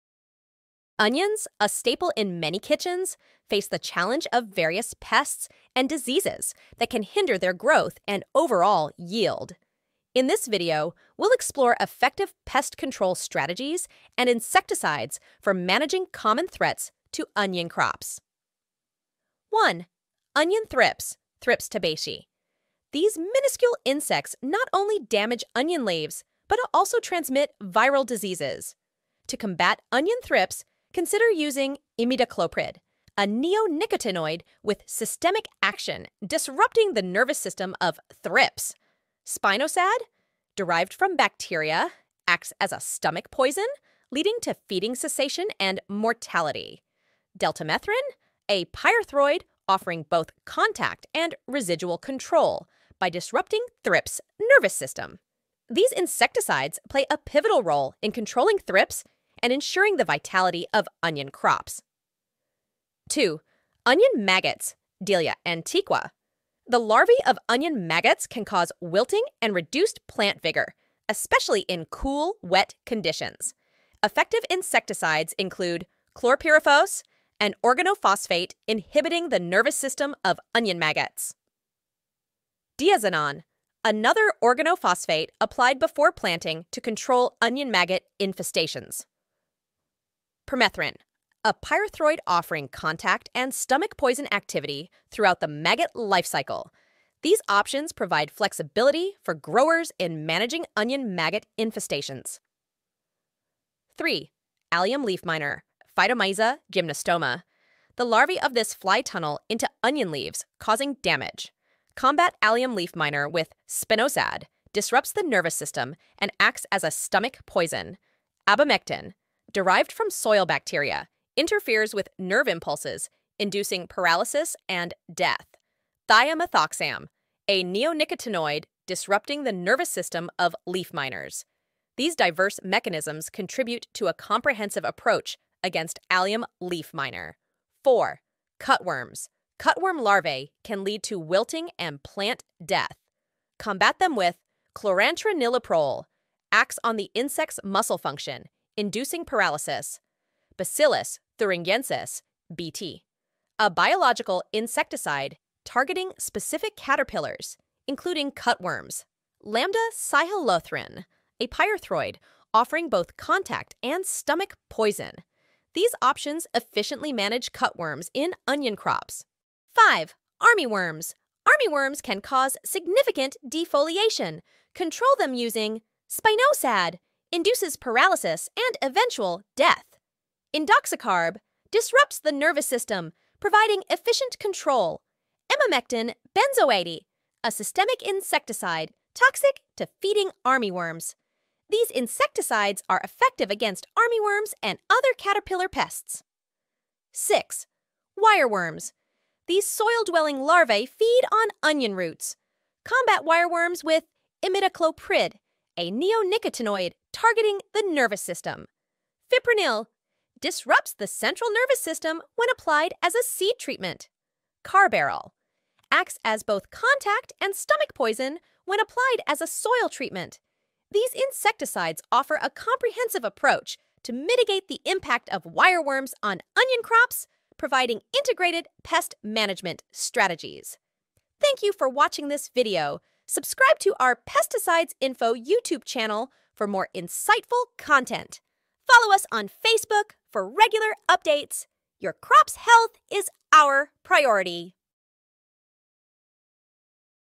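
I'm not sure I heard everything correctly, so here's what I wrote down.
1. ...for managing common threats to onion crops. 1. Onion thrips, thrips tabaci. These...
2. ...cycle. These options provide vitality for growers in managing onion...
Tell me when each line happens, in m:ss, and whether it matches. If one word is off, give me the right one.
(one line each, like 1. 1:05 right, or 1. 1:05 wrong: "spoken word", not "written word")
1. 0:15 right
2. 1:36 wrong: "flexibility", not "vitality".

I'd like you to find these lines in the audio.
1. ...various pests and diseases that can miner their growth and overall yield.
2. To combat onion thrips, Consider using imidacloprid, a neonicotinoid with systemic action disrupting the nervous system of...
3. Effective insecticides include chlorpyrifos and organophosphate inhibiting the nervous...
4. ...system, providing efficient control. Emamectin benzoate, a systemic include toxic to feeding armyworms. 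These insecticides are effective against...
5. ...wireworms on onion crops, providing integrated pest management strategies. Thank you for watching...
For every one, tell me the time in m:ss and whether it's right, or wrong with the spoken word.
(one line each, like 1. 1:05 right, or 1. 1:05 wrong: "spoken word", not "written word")
1. 0:04 wrong: "hinder", not "miner"
2. 0:29 right
3. 1:14 right
4. 3:02 wrong: "insecticide", not "include"
5. 3:45 right.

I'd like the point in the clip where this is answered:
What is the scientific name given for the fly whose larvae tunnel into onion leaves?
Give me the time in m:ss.
1:45.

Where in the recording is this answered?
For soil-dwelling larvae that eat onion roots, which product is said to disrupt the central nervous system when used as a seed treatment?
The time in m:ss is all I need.
3:29.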